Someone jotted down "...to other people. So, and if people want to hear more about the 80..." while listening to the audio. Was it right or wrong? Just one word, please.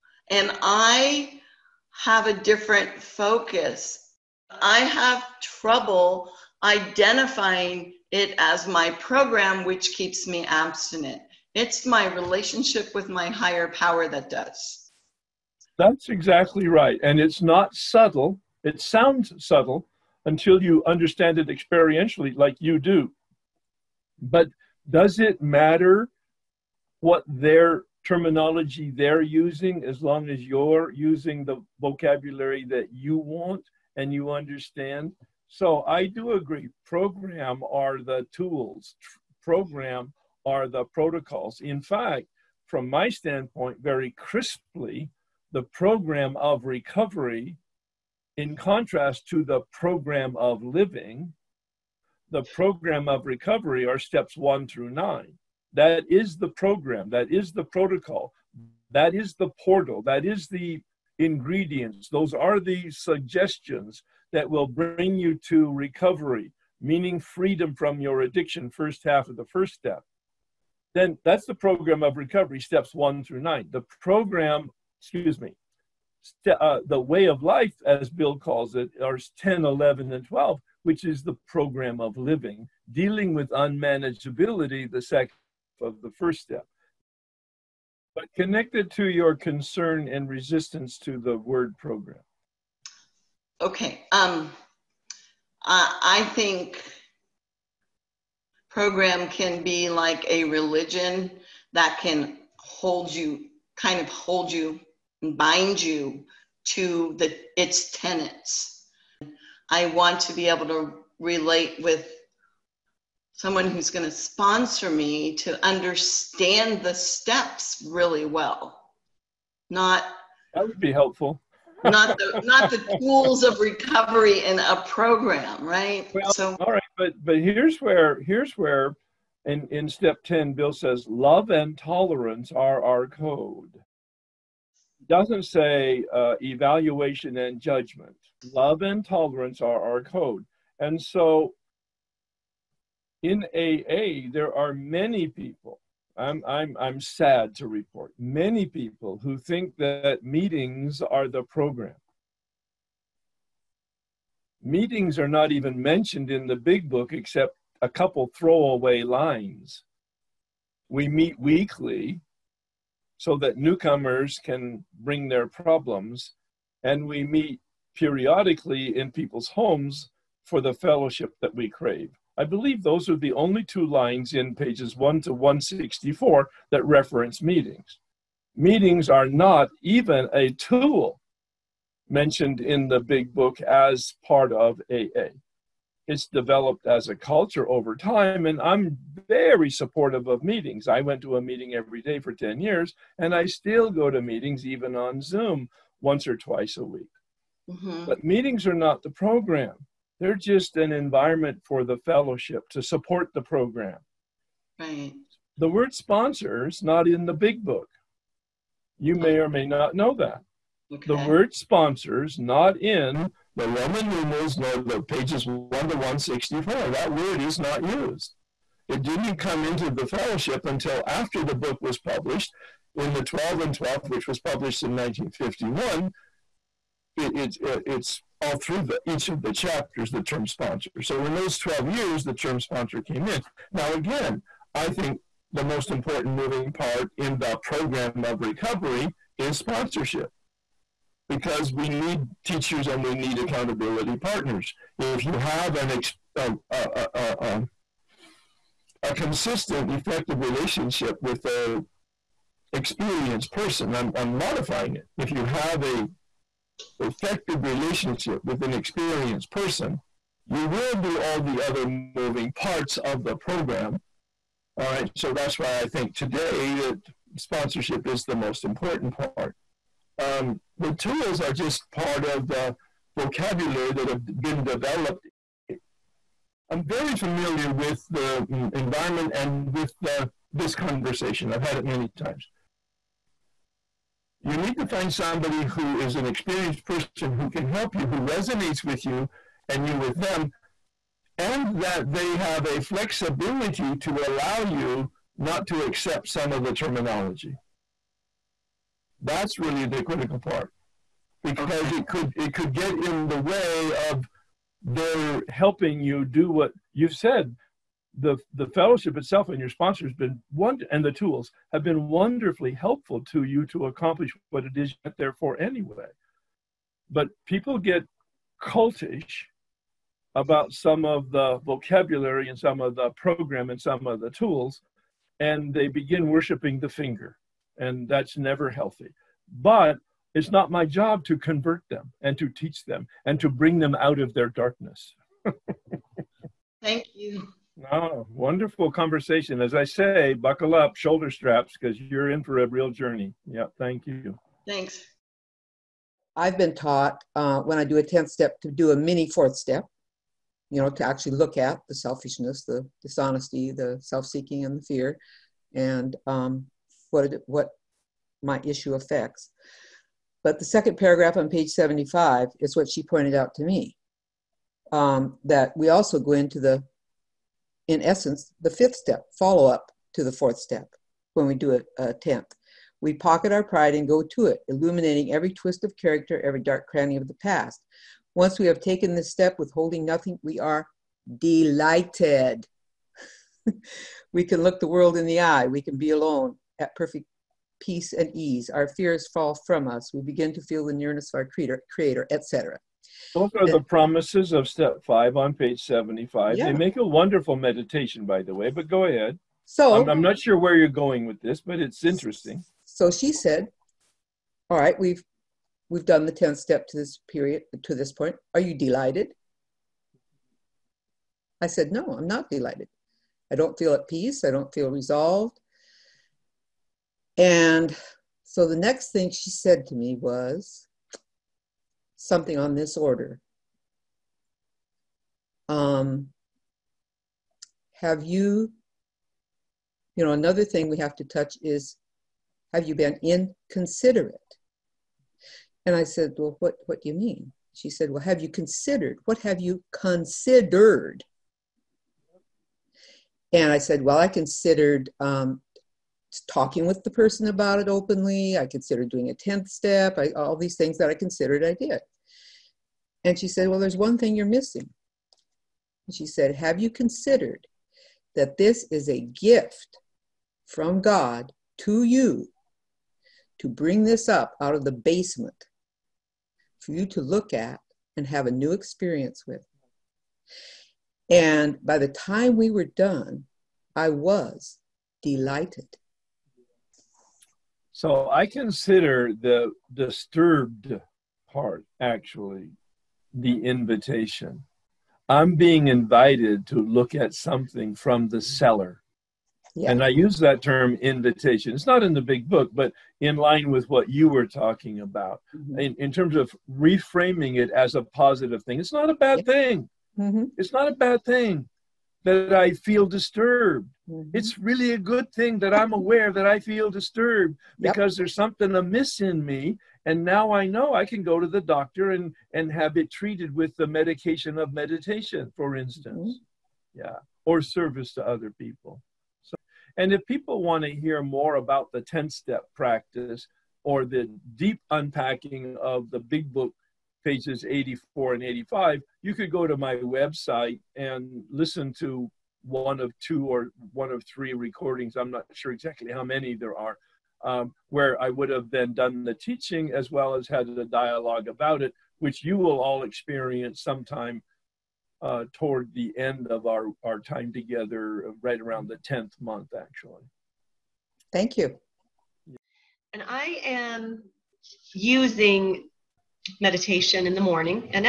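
wrong.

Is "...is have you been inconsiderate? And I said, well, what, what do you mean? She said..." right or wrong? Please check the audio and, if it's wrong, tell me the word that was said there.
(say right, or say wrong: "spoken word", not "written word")
right.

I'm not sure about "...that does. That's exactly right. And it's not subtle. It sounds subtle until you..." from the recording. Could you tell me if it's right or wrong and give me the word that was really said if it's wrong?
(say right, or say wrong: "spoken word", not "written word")
right.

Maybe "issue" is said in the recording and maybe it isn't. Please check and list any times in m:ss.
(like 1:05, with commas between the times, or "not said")
5:58.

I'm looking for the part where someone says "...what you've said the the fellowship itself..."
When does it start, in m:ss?
5:06.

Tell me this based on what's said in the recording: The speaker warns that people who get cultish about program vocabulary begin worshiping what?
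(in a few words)
The finger.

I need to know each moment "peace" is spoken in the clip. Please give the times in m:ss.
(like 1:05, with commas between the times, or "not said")
6:27, 6:54.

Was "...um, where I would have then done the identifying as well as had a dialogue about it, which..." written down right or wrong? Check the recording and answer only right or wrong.
wrong.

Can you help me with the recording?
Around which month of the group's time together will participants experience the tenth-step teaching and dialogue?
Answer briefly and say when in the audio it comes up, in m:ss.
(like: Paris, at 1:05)
10th month, at 9:08.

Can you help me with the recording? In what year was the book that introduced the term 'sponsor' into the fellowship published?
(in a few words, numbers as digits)
1951.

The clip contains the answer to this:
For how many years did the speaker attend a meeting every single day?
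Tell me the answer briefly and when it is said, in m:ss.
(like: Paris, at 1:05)
10, at 3:12.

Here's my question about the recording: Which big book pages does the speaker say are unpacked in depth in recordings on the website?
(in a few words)
84 and 85.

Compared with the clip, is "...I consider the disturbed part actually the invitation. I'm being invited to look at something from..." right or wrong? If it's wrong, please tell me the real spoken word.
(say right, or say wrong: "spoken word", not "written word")
right.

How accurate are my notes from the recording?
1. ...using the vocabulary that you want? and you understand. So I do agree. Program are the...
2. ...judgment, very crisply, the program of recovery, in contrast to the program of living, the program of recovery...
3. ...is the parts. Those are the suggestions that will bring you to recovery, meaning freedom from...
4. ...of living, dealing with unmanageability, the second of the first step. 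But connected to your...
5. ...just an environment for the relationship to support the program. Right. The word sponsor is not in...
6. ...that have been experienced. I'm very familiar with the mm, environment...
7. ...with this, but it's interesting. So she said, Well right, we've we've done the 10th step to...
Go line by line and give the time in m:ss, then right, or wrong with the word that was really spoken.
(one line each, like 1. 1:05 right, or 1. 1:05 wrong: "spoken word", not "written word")
1. 0:30 right
2. 0:43 wrong: "standpoint", not "judgment"
3. 1:00 wrong: "ingredients", not "parts"
4. 1:22 right
5. 3:20 wrong: "fellowship", not "relationship"
6. 4:33 wrong: "developed", not "experienced"
7. 6:41 wrong: "All", not "Well".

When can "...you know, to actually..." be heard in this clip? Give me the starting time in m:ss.
5:50.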